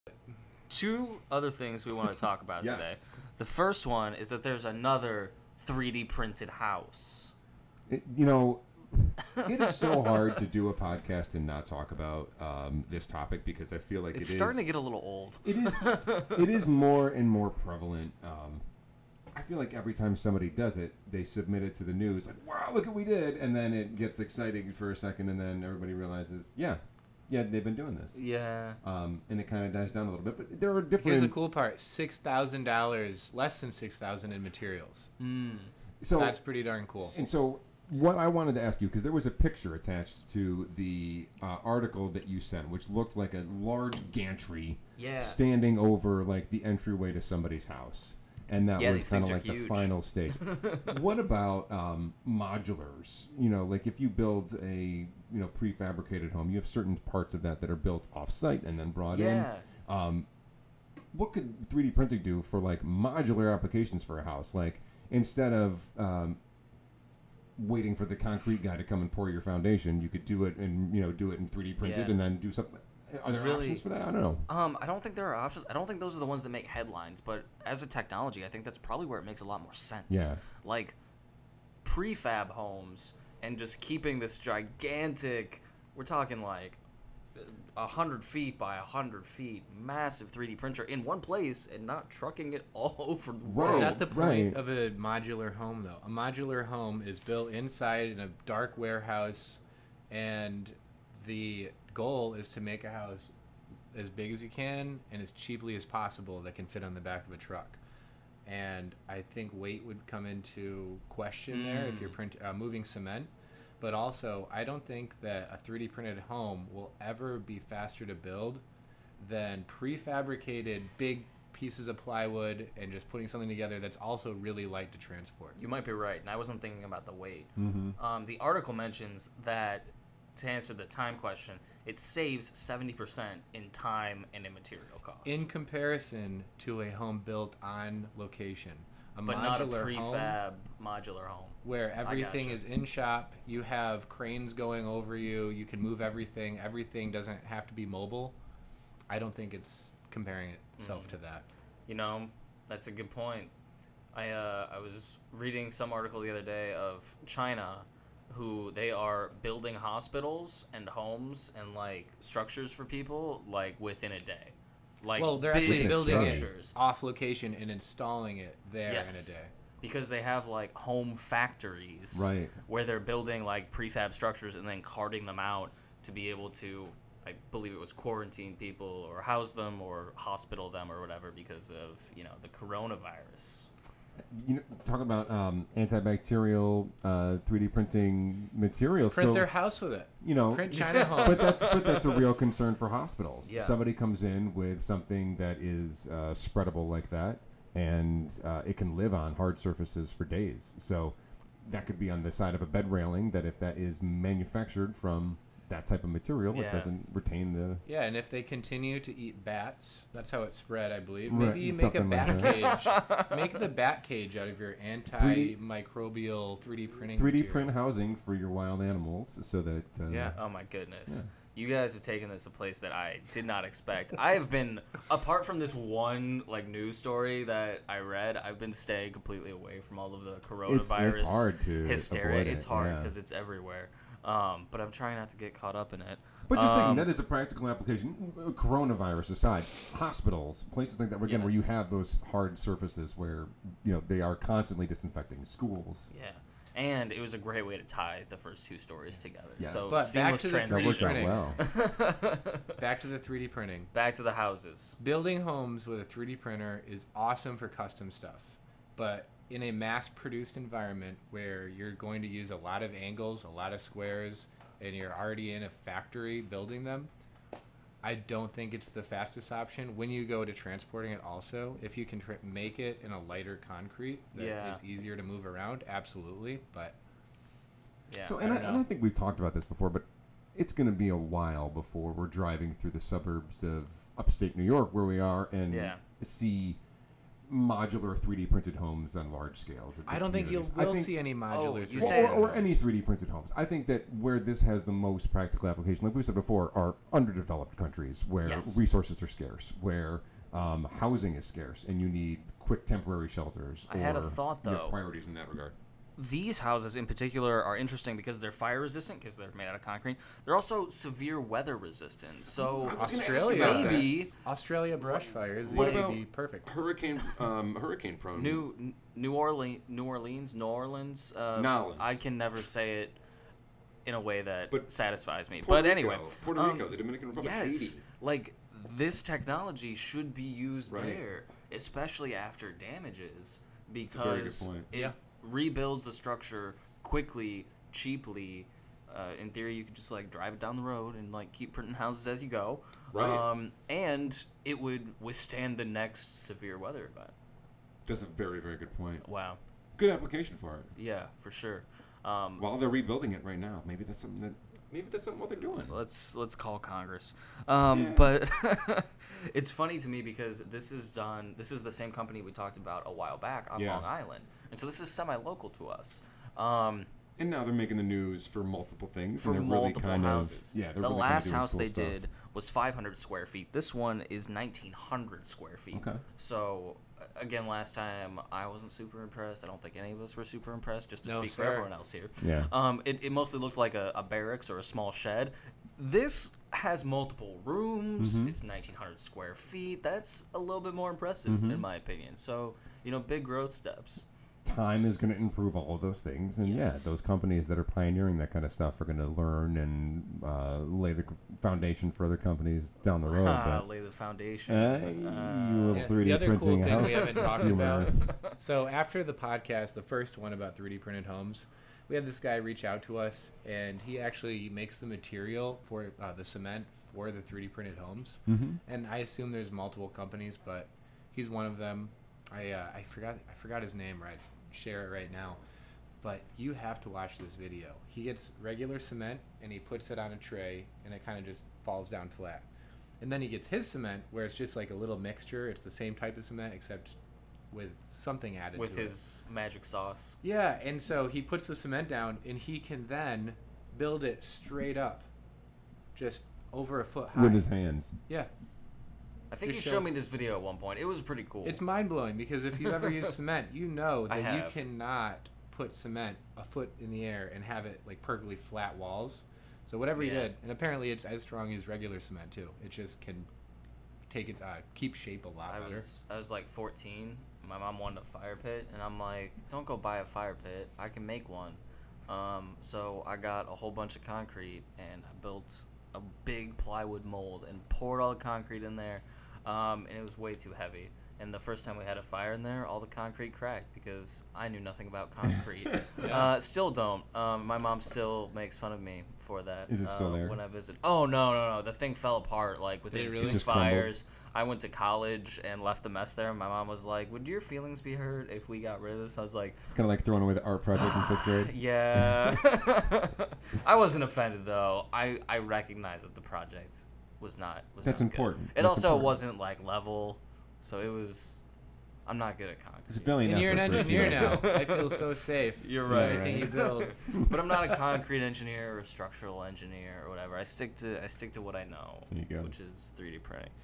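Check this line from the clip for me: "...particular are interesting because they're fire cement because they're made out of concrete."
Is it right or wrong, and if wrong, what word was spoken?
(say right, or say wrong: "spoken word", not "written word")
wrong: "resistant", not "cement".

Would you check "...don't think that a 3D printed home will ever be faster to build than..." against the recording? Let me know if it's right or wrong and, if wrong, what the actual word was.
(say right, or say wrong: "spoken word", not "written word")
right.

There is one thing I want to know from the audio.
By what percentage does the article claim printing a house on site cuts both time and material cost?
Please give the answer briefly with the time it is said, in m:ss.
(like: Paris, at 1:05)
70%, at 2:12.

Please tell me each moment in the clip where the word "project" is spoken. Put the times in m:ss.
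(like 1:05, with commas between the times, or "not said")
8:20, 8:26.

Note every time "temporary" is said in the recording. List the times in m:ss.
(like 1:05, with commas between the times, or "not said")
5:02.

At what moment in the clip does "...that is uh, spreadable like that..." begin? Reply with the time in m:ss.
3:15.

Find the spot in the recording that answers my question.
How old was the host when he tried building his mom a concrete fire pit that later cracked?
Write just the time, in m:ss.
7:46.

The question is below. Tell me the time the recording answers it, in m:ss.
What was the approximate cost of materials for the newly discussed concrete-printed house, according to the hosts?
0:33.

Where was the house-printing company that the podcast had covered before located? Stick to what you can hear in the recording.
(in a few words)
Long Island.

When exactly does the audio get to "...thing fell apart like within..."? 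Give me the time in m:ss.
8:11.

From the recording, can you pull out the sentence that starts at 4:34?
is easier to move around, absolutely.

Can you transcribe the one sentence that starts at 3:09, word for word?
Print so, their house with it.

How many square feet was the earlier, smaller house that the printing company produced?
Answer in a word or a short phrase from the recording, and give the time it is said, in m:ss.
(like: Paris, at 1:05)
500, at 6:12.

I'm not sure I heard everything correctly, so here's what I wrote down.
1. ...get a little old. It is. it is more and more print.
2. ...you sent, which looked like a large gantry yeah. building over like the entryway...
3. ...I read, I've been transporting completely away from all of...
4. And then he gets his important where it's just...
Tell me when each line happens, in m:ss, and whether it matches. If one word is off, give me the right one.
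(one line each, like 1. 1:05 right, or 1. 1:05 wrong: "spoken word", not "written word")
1. 0:14 wrong: "prevalent", not "print"
2. 0:42 wrong: "standing", not "building"
3. 3:47 wrong: "staying", not "transporting"
4. 7:13 wrong: "cement", not "important".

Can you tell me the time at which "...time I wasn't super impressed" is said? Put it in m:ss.
6:17.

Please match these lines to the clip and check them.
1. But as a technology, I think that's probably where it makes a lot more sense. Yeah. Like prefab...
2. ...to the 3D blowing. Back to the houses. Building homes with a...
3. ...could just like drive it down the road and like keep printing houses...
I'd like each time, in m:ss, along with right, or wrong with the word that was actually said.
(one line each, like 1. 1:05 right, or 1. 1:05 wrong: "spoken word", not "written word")
1. 1:17 right
2. 4:13 wrong: "printing", not "blowing"
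3. 5:39 right.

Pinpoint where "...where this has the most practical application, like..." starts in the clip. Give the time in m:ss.
4:54.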